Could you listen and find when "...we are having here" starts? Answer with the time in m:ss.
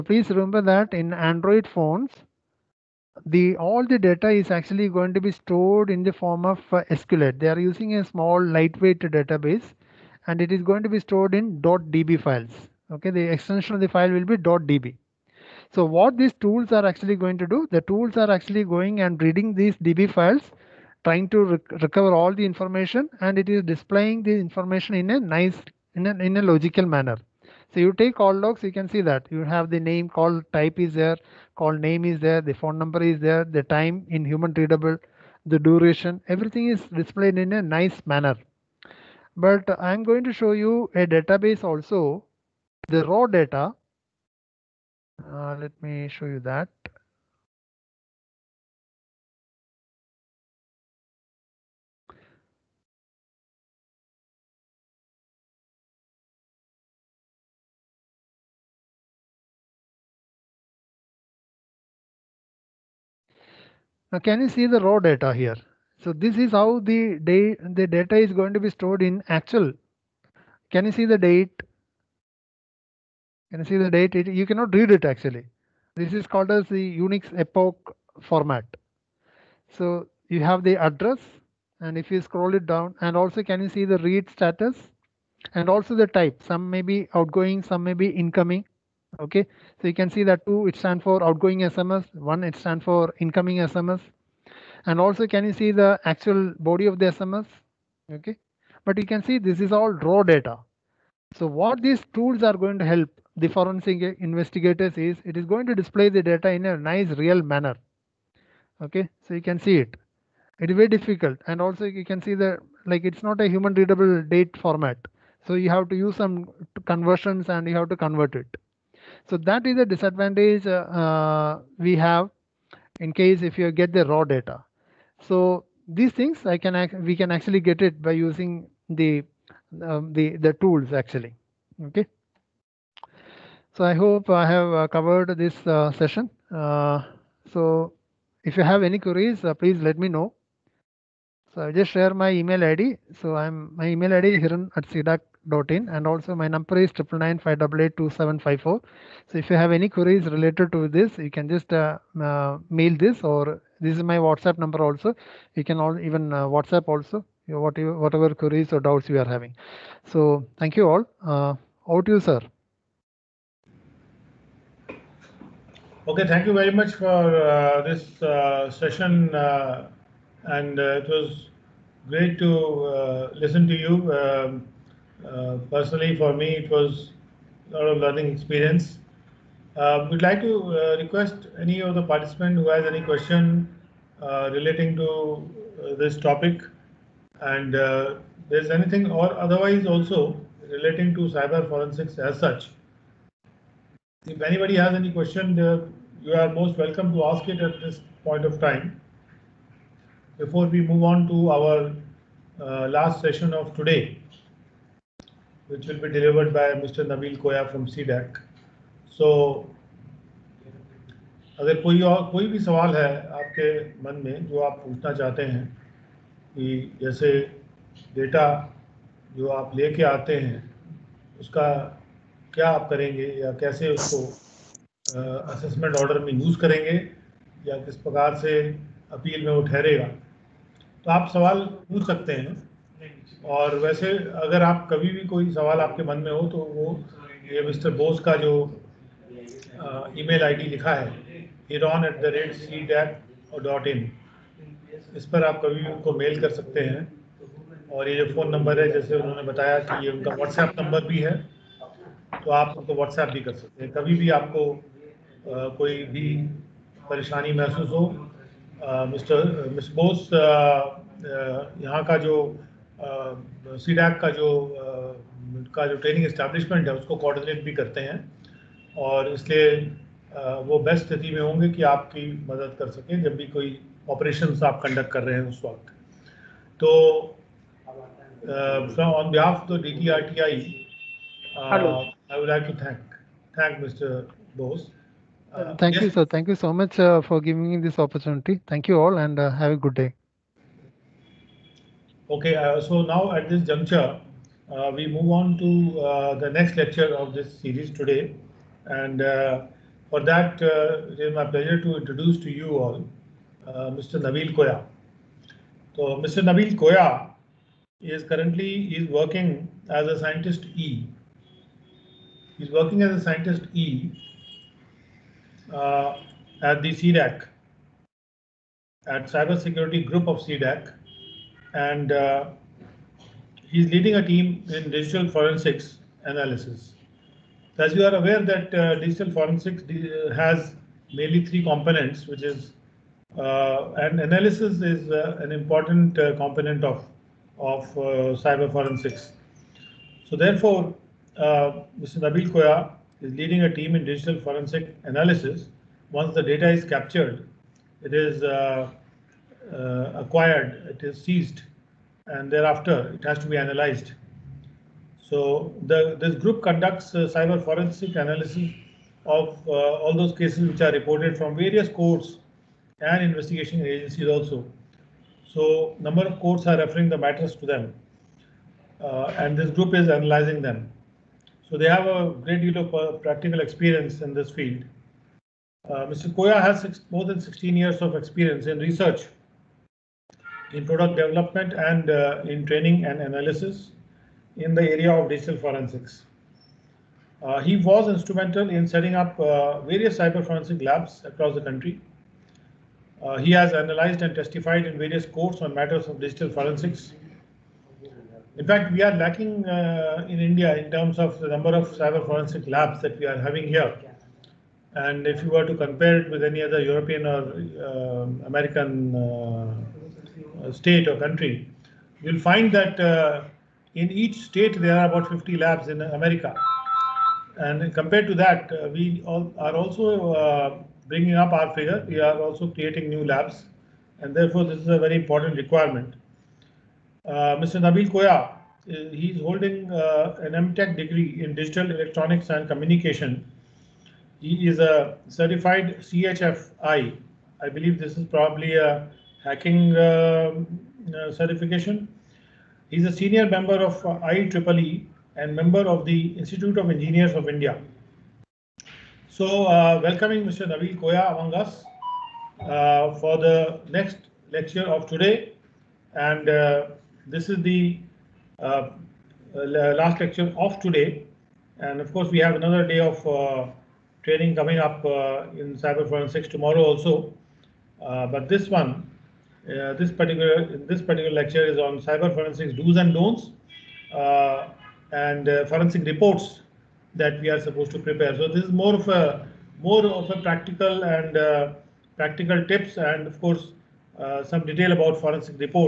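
6:43.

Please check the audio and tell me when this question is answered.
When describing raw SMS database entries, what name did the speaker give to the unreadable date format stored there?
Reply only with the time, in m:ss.
1:16.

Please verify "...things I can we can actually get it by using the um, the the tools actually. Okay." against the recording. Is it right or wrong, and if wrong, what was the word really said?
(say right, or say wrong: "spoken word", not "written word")
right.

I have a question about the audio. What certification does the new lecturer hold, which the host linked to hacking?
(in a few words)
CHFI.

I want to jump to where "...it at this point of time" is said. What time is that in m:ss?
3:17.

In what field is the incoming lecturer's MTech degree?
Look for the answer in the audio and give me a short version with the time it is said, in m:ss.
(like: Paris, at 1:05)
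Digital Electronics and Communication, at 7:11.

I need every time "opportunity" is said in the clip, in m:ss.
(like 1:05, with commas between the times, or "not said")
4:48.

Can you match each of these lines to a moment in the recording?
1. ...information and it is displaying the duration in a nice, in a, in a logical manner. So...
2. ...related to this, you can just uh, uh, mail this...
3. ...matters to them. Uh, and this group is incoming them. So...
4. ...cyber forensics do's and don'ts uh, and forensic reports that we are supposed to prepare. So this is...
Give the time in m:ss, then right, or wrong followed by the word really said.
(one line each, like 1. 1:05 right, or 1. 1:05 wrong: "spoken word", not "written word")
1. 0:22 wrong: "information", not "duration"
2. 2:30 right
3. 6:07 wrong: "analyzing", not "incoming"
4. 7:51 right.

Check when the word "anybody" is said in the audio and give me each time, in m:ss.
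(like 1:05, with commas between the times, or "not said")
3:14.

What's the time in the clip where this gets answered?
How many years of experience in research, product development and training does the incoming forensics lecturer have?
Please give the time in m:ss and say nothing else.
6:17.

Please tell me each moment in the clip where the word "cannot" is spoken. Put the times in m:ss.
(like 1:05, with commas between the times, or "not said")
1:14.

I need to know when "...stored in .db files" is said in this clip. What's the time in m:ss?
0:10.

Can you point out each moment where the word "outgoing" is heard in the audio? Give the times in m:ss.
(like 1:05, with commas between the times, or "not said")
1:27, 1:31.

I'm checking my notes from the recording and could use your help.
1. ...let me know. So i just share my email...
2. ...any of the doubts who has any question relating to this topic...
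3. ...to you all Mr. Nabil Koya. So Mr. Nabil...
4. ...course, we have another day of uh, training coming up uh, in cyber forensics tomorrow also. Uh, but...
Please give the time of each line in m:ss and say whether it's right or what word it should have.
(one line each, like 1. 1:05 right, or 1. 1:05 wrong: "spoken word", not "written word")
1. 2:19 right
2. 3:01 wrong: "participants", not "doubts"
3. 5:02 right
4. 7:42 right.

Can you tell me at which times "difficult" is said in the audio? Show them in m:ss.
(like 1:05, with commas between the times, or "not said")
1:50.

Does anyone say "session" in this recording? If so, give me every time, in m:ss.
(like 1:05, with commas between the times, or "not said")
2:15, 2:48, 3:23.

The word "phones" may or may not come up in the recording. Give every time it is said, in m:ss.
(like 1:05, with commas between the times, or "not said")
0:01, 0:32.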